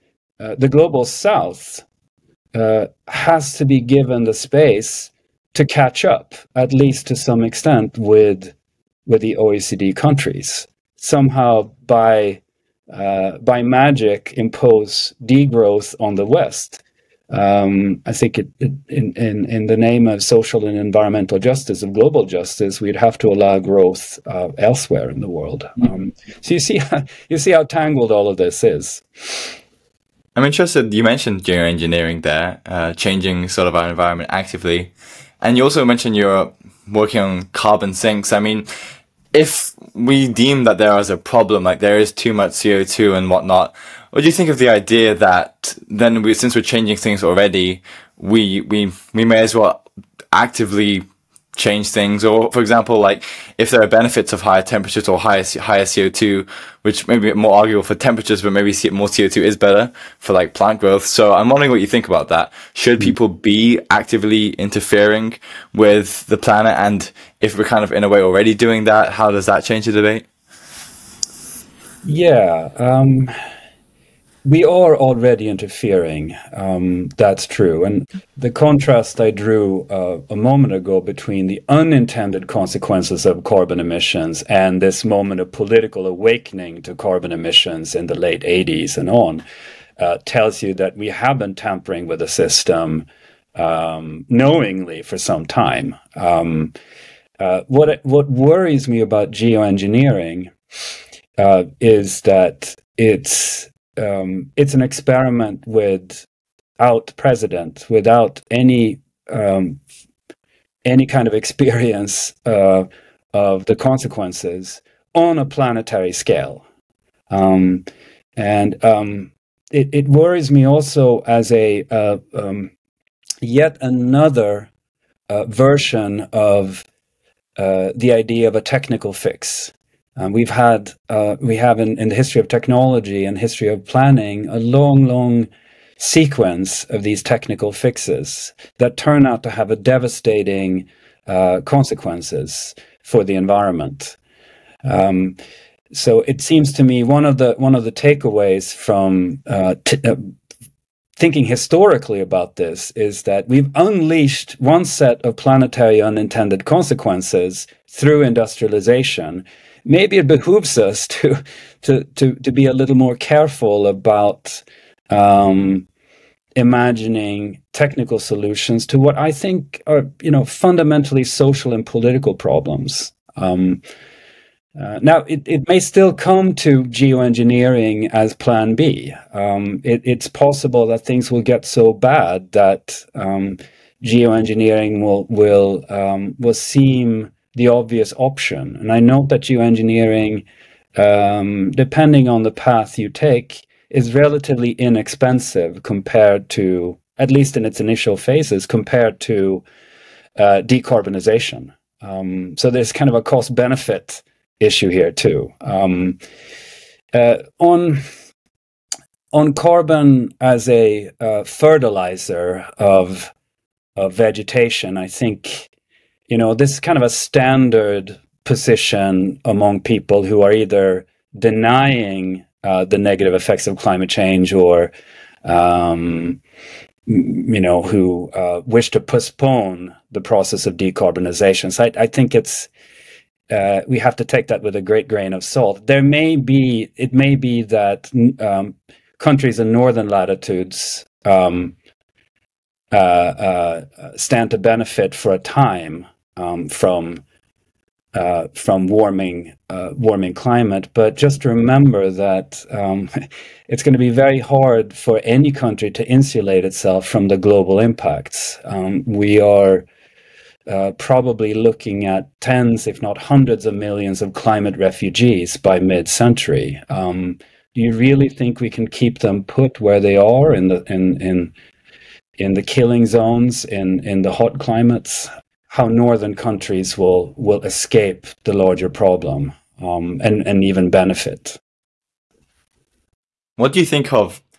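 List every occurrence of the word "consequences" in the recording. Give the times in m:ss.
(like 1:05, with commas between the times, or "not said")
1:22, 1:53, 2:21, 2:36.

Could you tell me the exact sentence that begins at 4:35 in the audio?
how northern countries will will escape the larger problem um, and and even benefit.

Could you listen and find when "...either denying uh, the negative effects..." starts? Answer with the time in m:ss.
3:40.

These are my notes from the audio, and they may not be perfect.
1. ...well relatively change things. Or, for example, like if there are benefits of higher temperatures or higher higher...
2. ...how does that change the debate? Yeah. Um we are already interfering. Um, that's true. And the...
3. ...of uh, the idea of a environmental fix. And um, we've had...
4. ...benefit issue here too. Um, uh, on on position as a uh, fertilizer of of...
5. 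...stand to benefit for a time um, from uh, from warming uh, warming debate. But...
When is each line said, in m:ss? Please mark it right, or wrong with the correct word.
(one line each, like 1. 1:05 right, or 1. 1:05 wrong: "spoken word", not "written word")
1. 0:49 wrong: "actively", not "relatively"
2. 1:09 right
3. 2:06 wrong: "technical", not "environmental"
4. 3:23 wrong: "carbon", not "position"
5. 4:04 wrong: "climate", not "debate".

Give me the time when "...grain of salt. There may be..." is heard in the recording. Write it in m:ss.
3:55.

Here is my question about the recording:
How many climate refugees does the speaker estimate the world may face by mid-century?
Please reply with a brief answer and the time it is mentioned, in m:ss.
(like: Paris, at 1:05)
tens, if not hundreds of millions, at 4:22.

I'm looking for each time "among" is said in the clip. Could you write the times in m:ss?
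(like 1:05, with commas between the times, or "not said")
3:39.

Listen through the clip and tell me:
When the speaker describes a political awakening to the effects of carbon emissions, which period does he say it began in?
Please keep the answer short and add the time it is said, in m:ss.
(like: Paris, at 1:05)
late 80s, at 1:28.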